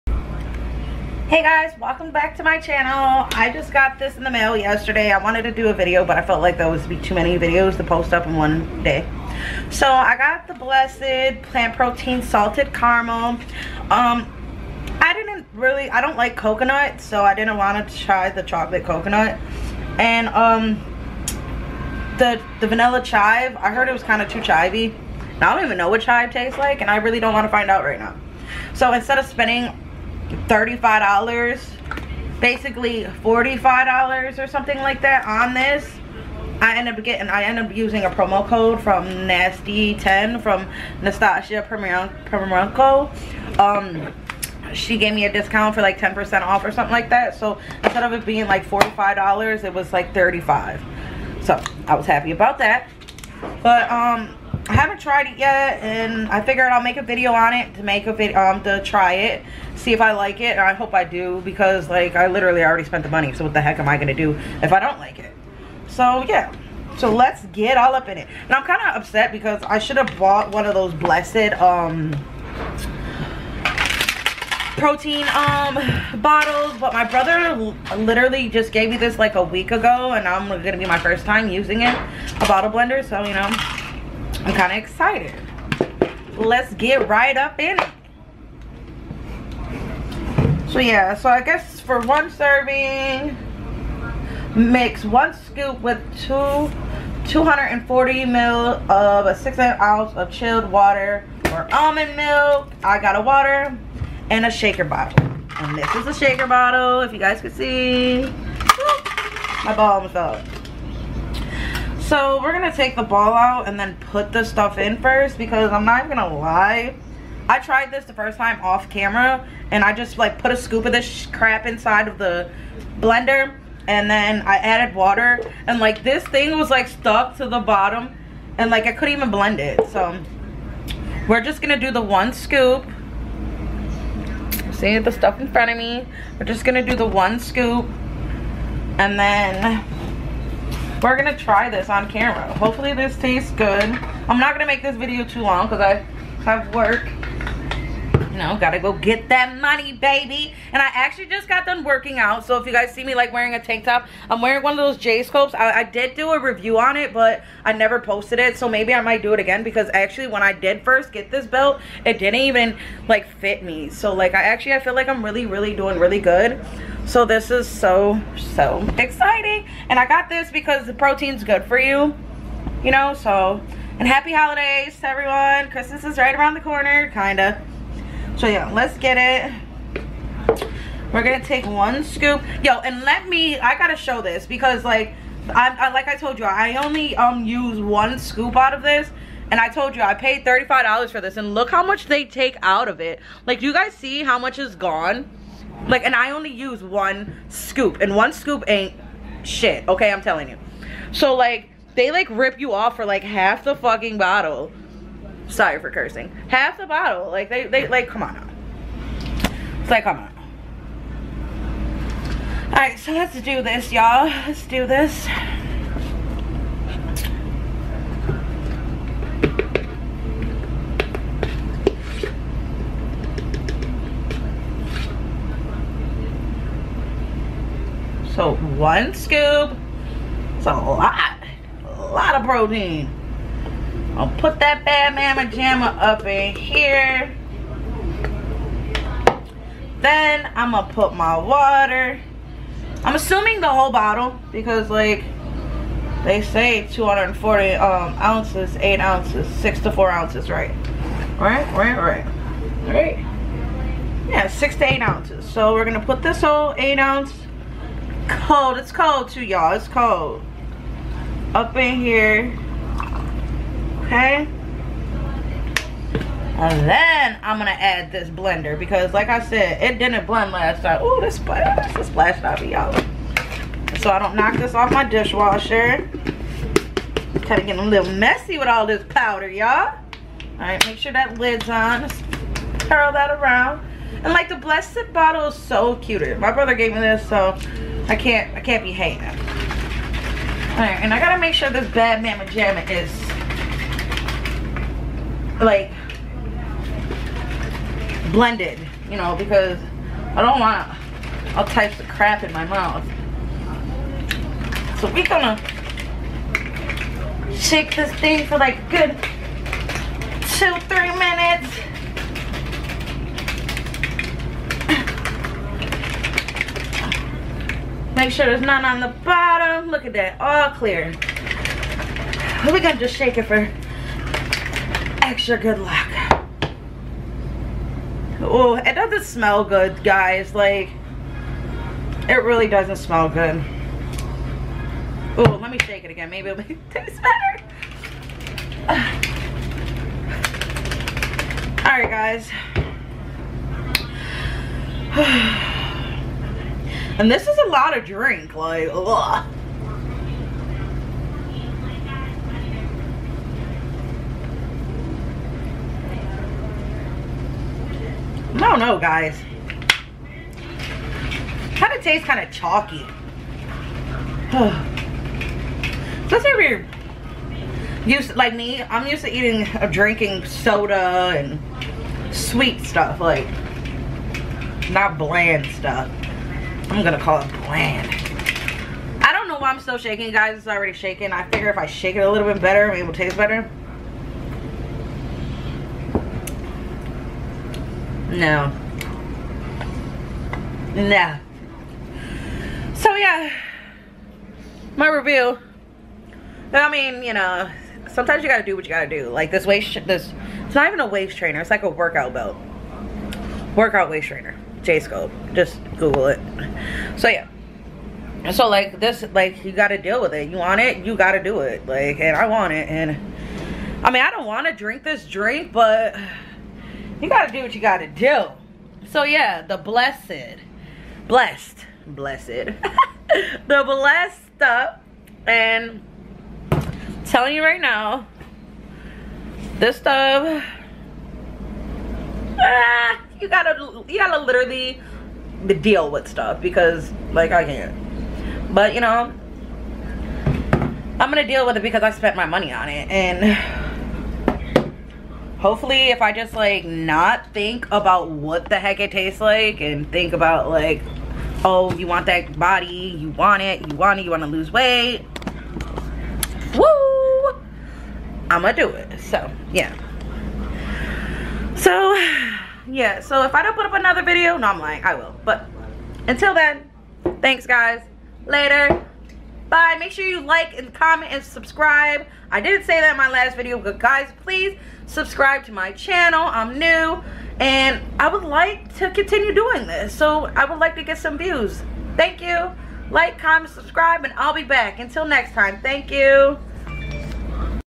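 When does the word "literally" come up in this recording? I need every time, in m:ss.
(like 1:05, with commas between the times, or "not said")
1:02, 1:17, 7:14.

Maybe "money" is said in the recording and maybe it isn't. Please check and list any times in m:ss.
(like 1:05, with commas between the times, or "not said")
1:03, 2:29, 7:22.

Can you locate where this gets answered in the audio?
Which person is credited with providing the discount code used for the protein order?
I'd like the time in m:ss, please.
0:41.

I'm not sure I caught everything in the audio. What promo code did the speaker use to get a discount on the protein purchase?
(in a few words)
nasty10.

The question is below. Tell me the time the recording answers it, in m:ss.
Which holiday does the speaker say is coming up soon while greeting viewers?
2:55.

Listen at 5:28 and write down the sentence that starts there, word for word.
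Oh, it doesn't smell good, guys.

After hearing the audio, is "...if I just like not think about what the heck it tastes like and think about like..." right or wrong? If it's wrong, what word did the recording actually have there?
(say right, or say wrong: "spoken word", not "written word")
right.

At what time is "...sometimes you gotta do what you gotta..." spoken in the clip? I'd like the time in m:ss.
6:38.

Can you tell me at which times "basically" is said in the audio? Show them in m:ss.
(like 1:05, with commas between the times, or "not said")
0:32.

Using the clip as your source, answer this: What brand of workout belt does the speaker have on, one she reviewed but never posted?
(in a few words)
J scopes.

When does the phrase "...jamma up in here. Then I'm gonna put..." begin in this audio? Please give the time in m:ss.
3:55.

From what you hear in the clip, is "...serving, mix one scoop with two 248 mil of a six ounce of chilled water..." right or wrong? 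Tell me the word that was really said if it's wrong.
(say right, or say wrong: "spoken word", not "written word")
wrong: "240", not "248".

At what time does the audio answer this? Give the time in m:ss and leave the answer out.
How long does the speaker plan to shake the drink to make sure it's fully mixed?
5:10.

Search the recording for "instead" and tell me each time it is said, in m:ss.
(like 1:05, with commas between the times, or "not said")
0:28, 0:47.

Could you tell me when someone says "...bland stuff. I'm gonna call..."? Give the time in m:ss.
6:15.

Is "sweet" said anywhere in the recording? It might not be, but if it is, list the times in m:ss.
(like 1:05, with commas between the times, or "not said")
6:12.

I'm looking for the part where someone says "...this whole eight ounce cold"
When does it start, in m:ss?
4:16.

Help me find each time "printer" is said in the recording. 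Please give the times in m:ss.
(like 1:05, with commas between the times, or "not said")
not said.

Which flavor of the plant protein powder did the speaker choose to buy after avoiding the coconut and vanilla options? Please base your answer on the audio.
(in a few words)
Salted Caramel.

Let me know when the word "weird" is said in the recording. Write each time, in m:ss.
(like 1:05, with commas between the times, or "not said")
6:06.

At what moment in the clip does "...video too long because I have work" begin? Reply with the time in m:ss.
2:24.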